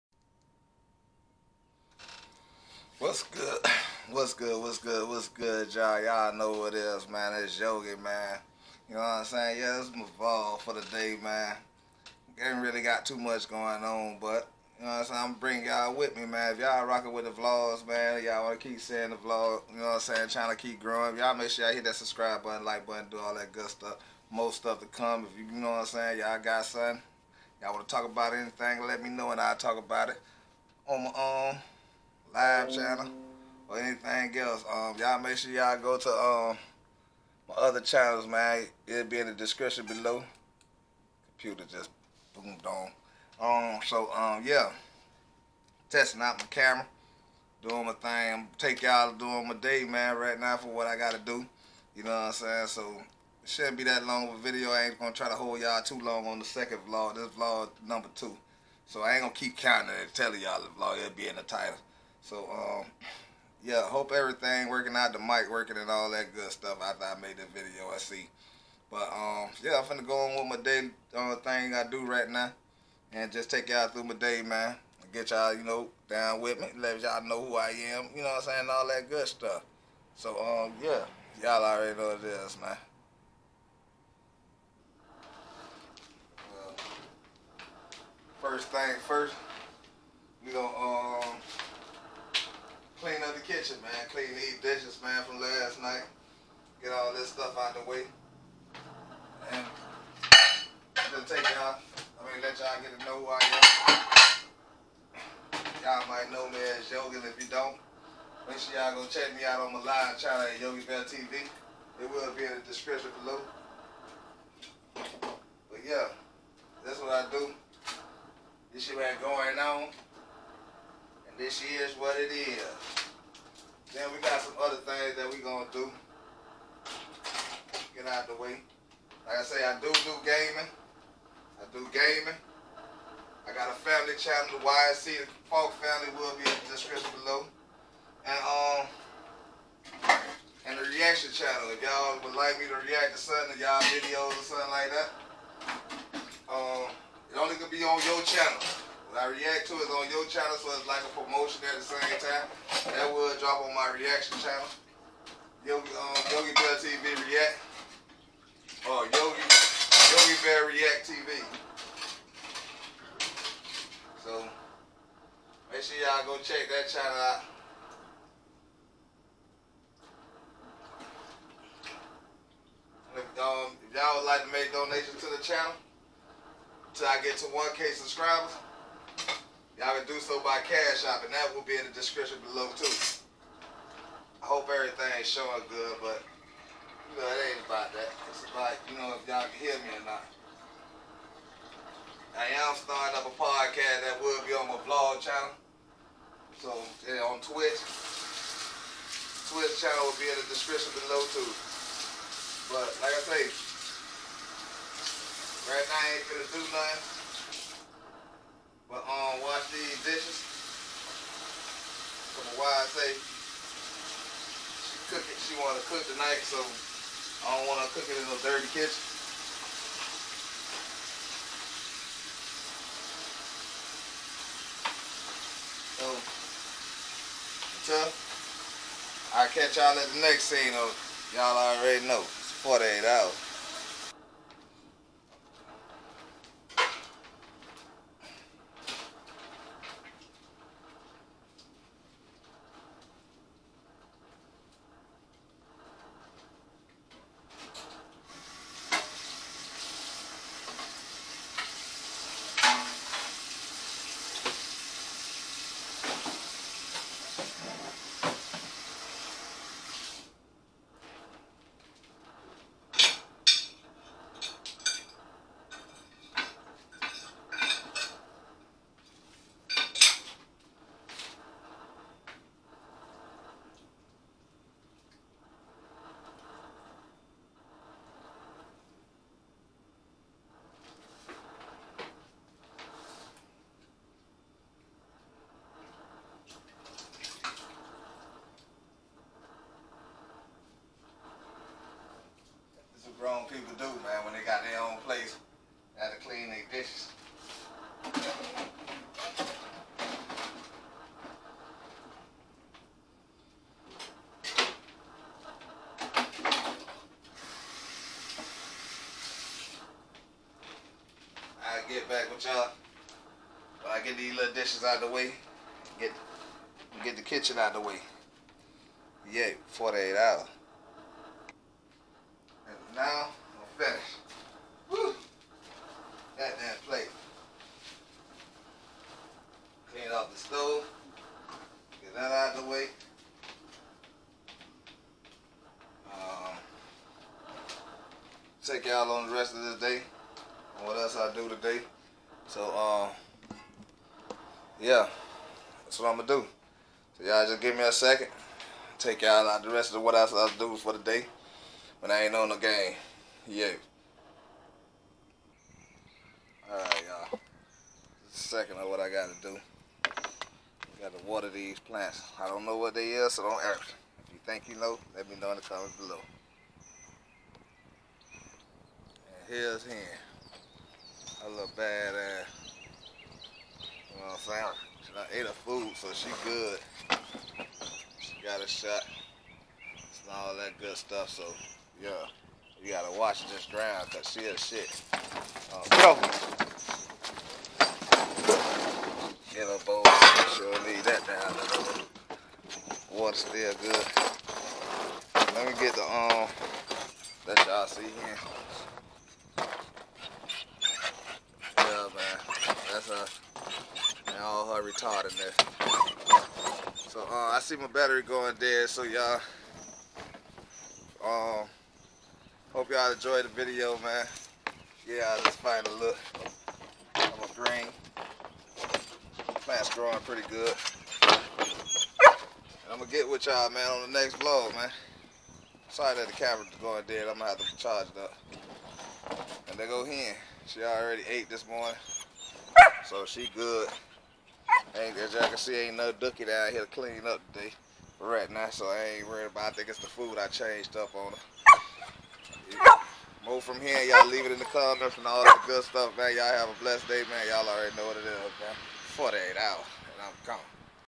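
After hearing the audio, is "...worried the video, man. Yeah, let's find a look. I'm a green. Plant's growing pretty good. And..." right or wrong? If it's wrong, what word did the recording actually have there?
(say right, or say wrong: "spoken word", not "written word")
wrong: "enjoyed", not "worried".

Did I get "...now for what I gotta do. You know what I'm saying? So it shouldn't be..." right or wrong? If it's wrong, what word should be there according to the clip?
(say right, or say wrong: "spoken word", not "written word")
right.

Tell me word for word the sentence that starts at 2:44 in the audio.
So, make sure y'all go check that channel out.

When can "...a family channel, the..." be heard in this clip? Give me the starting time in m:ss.
2:13.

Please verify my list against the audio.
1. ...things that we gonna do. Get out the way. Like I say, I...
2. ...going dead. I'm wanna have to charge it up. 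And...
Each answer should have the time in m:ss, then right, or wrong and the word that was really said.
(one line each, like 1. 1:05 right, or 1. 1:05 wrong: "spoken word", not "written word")
1. 2:04 right
2. 7:06 wrong: "gonna", not "wanna".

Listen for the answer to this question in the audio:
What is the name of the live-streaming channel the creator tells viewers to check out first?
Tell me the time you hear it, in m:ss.
1:50.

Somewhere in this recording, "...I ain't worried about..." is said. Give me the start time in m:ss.
7:18.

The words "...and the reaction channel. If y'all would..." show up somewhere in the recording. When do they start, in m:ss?
2:20.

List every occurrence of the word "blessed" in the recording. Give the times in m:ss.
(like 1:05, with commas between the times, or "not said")
7:26.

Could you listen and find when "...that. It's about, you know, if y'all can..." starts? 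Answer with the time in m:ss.
3:07.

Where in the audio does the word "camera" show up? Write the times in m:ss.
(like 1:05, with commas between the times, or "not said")
0:46, 7:06.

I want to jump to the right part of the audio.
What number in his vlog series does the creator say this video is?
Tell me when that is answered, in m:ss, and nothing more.
0:58.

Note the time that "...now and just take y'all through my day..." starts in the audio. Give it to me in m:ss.
1:12.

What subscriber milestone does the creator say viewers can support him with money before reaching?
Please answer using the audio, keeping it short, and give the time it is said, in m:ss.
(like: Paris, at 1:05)
1K, at 2:57.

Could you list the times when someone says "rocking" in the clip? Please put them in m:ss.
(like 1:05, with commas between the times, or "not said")
0:16.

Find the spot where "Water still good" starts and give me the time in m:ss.
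6:33.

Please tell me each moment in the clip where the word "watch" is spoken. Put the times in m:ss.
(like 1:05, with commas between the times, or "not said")
6:23.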